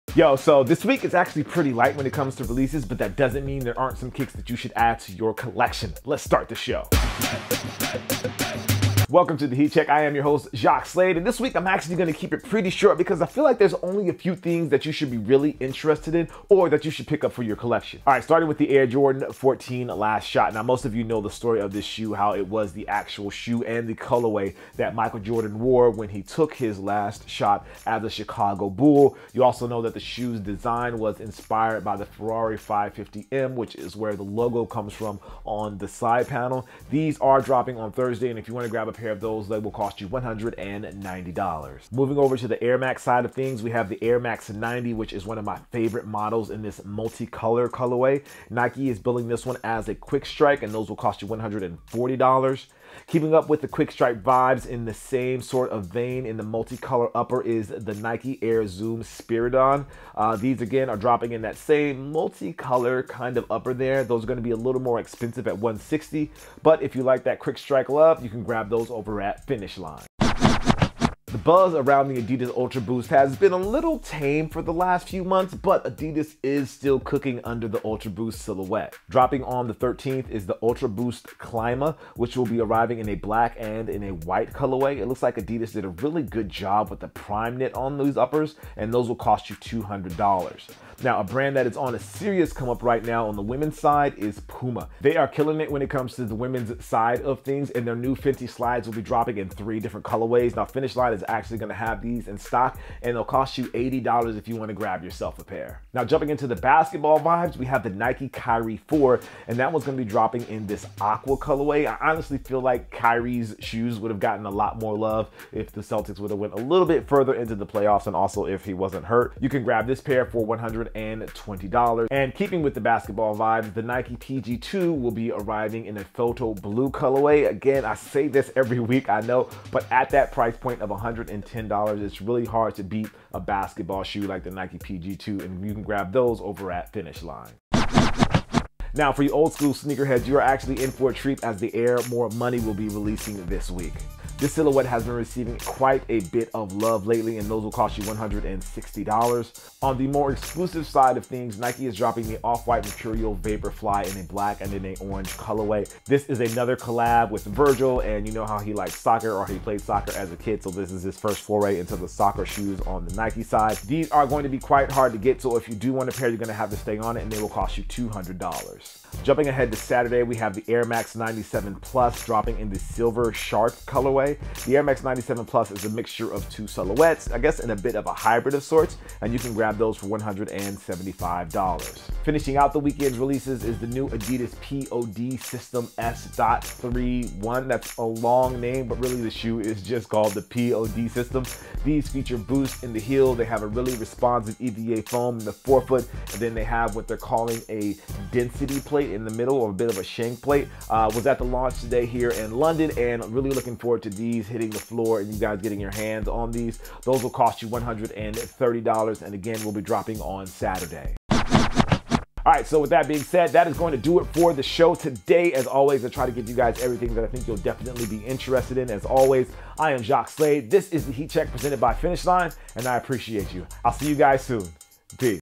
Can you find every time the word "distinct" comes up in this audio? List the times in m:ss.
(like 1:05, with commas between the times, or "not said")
not said.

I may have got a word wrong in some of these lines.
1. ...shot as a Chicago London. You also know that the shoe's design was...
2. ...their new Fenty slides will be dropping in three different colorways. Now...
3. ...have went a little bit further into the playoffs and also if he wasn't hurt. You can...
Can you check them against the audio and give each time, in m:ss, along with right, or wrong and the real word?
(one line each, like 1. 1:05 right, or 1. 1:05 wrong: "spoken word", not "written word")
1. 0:27 wrong: "Bull", not "London"
2. 1:37 right
3. 1:56 right.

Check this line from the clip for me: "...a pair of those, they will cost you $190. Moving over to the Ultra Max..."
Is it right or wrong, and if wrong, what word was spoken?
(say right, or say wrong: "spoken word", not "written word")
wrong: "Air", not "Ultra".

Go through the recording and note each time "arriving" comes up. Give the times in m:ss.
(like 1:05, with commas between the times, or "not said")
1:22, 2:05.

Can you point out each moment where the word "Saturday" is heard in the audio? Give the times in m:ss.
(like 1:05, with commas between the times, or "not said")
2:49, 3:30.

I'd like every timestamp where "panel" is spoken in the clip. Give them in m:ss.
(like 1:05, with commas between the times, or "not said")
0:36.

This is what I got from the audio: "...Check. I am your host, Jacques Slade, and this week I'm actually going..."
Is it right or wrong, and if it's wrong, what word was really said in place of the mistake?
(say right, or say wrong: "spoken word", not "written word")
right.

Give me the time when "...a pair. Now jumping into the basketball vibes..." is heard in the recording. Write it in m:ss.
1:45.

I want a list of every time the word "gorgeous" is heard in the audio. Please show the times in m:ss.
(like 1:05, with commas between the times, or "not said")
not said.